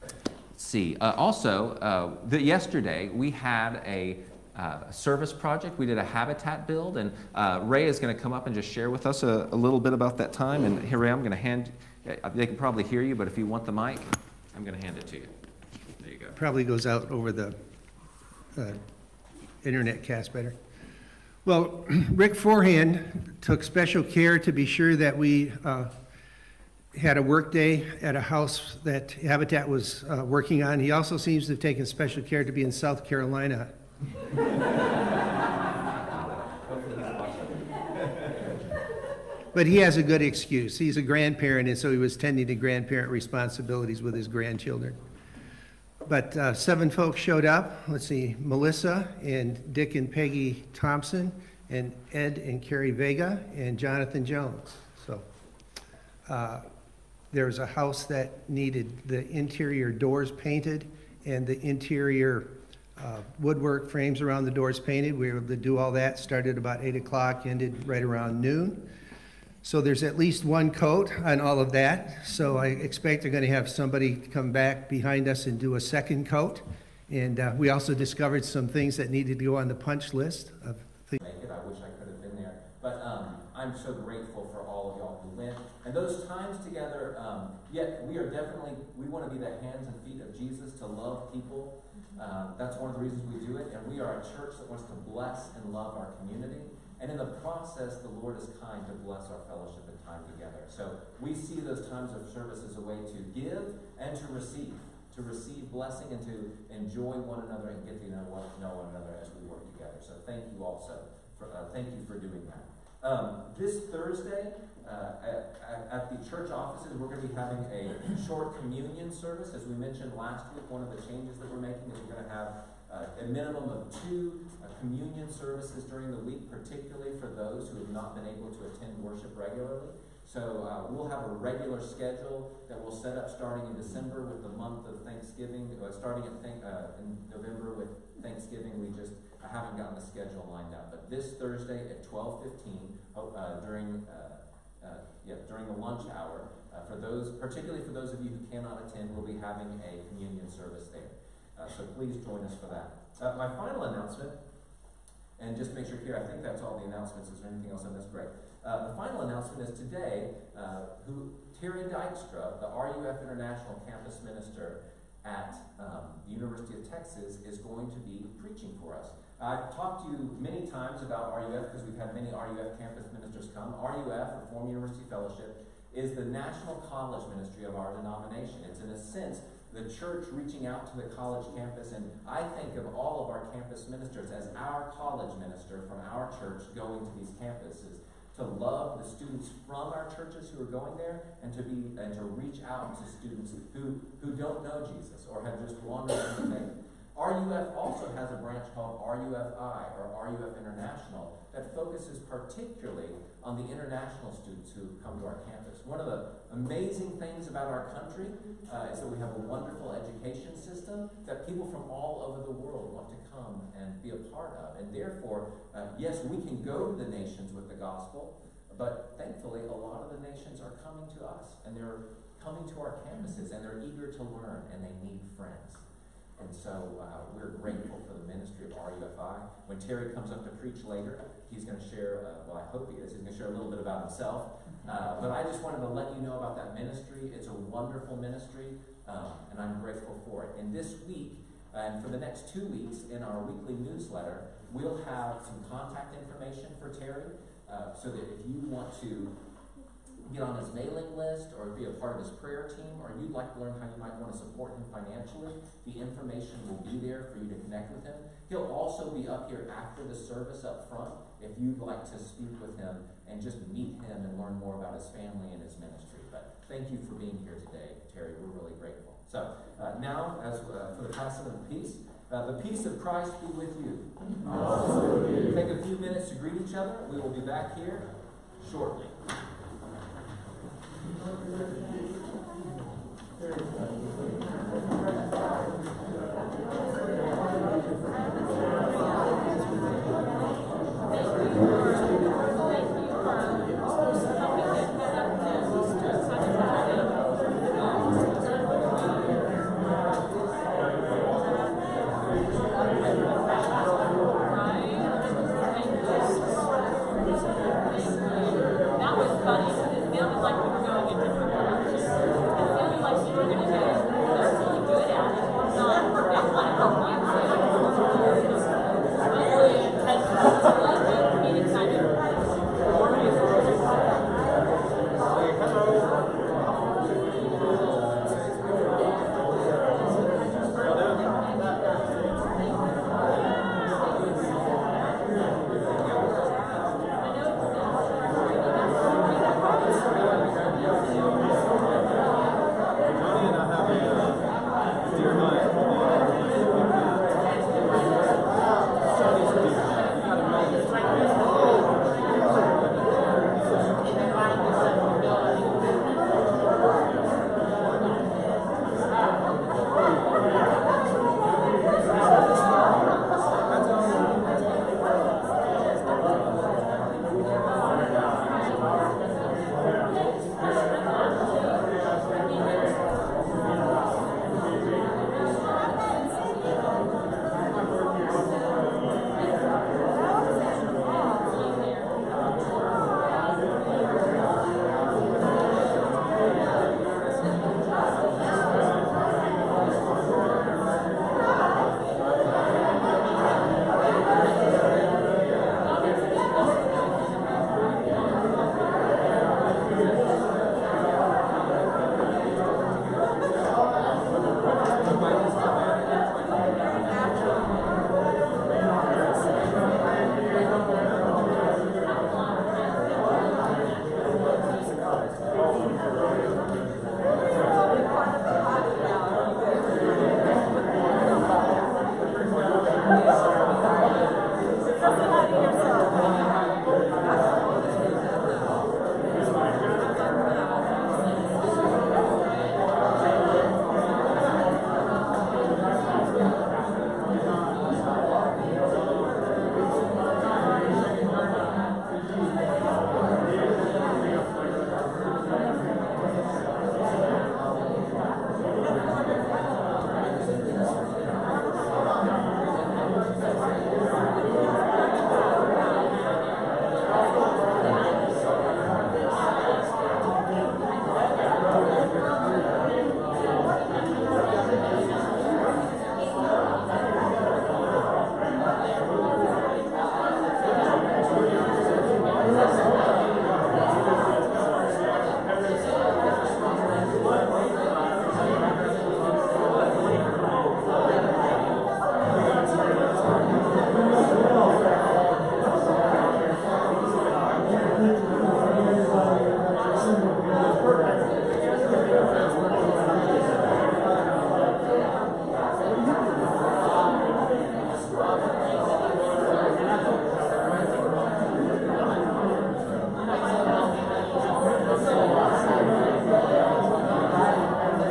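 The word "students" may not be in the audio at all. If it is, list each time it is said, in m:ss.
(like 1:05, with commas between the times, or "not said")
3:09, 3:13, 3:24.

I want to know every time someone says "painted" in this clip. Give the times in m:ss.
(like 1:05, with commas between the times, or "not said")
1:00, 1:04.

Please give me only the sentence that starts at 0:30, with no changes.
He also seems to have taken special care to be in South Carolina.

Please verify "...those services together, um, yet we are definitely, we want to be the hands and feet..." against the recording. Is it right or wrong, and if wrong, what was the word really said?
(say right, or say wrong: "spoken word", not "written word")
wrong: "times", not "services".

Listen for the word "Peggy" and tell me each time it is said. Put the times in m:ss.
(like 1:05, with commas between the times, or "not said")
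0:50.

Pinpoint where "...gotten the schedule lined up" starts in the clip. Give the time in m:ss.
2:19.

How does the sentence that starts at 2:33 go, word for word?
my final announcement, and just make sure here, I think that's all the announcements.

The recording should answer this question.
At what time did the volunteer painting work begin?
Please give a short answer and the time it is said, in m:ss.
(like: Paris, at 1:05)
8 o'clock, at 1:06.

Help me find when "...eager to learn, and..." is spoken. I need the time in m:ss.
3:43.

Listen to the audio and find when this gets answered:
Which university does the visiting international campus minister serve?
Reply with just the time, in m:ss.
2:46.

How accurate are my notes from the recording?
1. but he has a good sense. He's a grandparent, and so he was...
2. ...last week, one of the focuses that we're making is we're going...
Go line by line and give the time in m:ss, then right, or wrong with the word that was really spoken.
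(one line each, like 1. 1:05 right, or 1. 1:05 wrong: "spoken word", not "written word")
1. 0:39 wrong: "excuse", not "sense"
2. 2:00 wrong: "changes", not "focuses".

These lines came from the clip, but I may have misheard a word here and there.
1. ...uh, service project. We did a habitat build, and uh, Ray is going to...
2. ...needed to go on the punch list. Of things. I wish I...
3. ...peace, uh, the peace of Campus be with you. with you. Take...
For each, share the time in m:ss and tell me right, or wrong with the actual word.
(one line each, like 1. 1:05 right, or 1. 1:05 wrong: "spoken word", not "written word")
1. 0:04 right
2. 1:19 right
3. 4:31 wrong: "Christ", not "Campus".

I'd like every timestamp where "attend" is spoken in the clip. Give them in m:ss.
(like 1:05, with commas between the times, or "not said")
2:08, 2:28.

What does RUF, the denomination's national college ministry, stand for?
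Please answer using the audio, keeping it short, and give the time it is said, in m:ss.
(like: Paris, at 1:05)
Reform University Fellowship, at 2:54.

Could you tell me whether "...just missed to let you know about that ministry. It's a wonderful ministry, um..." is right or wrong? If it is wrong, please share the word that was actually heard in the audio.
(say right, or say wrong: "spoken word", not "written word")
wrong: "wanted", not "missed".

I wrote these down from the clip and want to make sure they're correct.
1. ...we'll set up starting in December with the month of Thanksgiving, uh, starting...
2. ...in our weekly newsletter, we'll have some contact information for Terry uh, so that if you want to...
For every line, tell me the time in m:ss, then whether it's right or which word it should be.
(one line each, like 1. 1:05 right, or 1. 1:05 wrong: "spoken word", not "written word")
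1. 2:12 right
2. 4:03 right.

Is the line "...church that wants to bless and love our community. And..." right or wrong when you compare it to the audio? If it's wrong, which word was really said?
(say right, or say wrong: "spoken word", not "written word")
right.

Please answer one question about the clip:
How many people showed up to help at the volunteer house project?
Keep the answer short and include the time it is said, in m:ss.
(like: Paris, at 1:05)
7, at 0:46.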